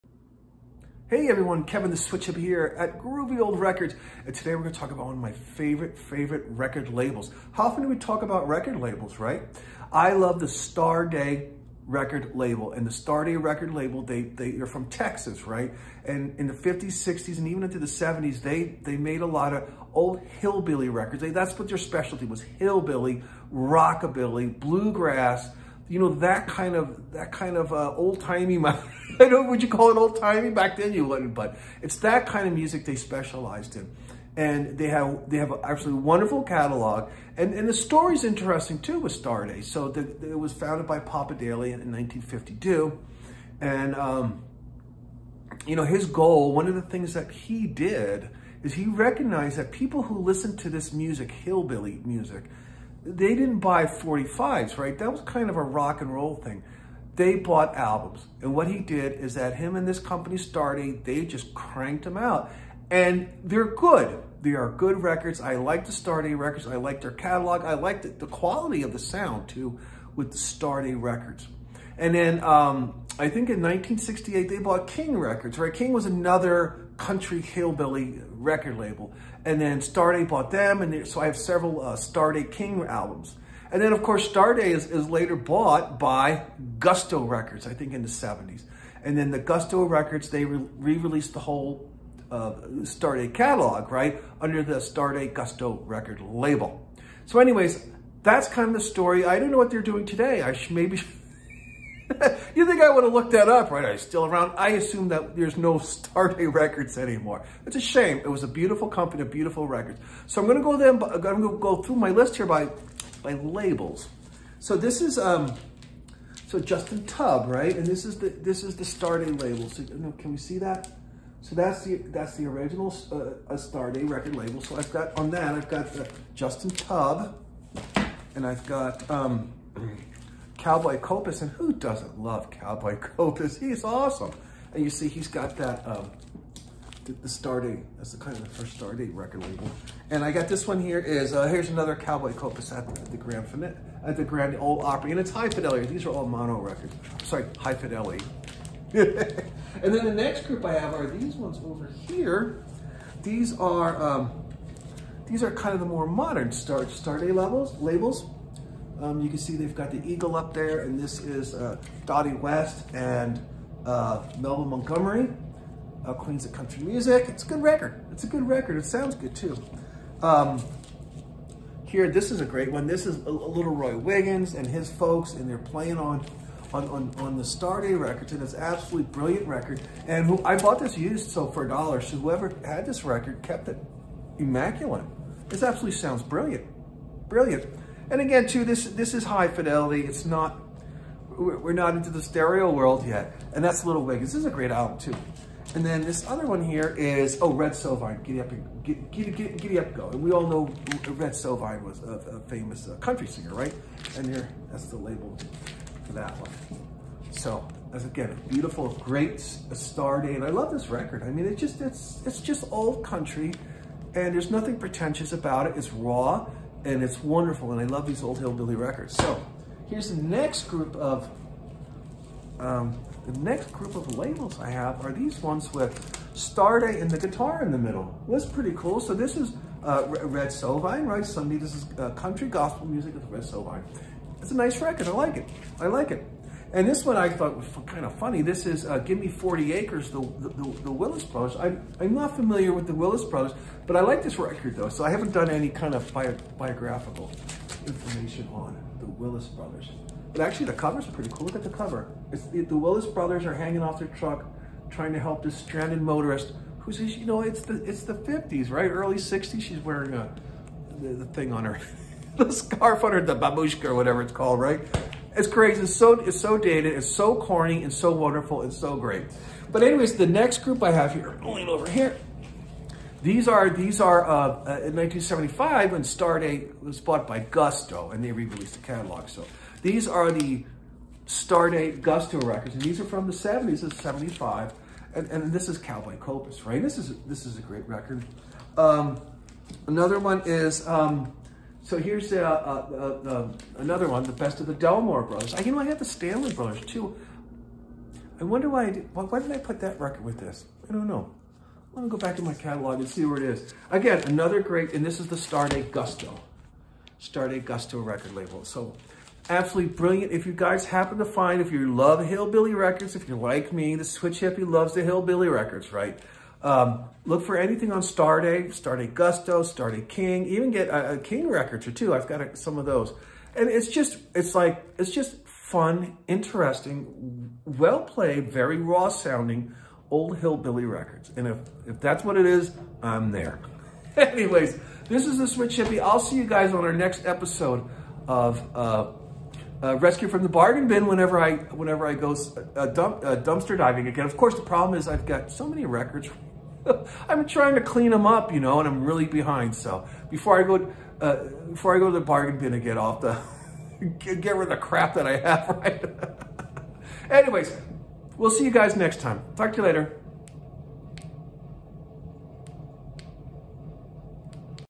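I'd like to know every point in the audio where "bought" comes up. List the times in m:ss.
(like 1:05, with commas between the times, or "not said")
0:57, 1:14, 1:20, 1:25, 3:00, 4:36.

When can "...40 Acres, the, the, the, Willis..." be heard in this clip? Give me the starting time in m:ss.
3:59.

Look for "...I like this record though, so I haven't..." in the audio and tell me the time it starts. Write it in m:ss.
4:03.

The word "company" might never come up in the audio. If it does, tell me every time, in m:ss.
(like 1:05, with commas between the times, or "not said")
0:59, 1:48.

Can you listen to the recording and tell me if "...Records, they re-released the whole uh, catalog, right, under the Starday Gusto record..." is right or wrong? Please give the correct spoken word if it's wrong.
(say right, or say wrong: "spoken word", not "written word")
right.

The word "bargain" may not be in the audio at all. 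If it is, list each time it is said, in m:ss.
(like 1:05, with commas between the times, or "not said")
5:40, 5:52.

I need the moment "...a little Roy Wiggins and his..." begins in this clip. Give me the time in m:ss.
2:53.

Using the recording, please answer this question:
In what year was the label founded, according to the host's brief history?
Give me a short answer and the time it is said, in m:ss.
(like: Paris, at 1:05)
1952, at 0:41.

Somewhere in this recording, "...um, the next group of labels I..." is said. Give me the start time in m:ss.
3:42.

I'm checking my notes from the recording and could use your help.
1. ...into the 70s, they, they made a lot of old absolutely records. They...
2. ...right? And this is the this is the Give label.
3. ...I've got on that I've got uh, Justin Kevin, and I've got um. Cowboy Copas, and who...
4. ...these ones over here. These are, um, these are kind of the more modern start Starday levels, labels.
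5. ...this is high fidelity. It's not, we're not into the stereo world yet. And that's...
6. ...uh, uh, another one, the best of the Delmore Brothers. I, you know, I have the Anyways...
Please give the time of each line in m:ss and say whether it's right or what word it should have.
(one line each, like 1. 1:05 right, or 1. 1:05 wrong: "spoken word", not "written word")
1. 0:17 wrong: "hillbilly", not "absolutely"
2. 1:57 wrong: "Starday", not "Give"
3. 2:04 wrong: "Tubb", not "Kevin"
4. 2:31 right
5. 3:08 right
6. 4:52 wrong: "Stanley", not "Anyways".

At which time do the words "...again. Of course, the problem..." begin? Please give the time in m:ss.
5:44.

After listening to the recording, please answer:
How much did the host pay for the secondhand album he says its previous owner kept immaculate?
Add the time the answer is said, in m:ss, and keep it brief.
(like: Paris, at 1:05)
$1, at 3:01.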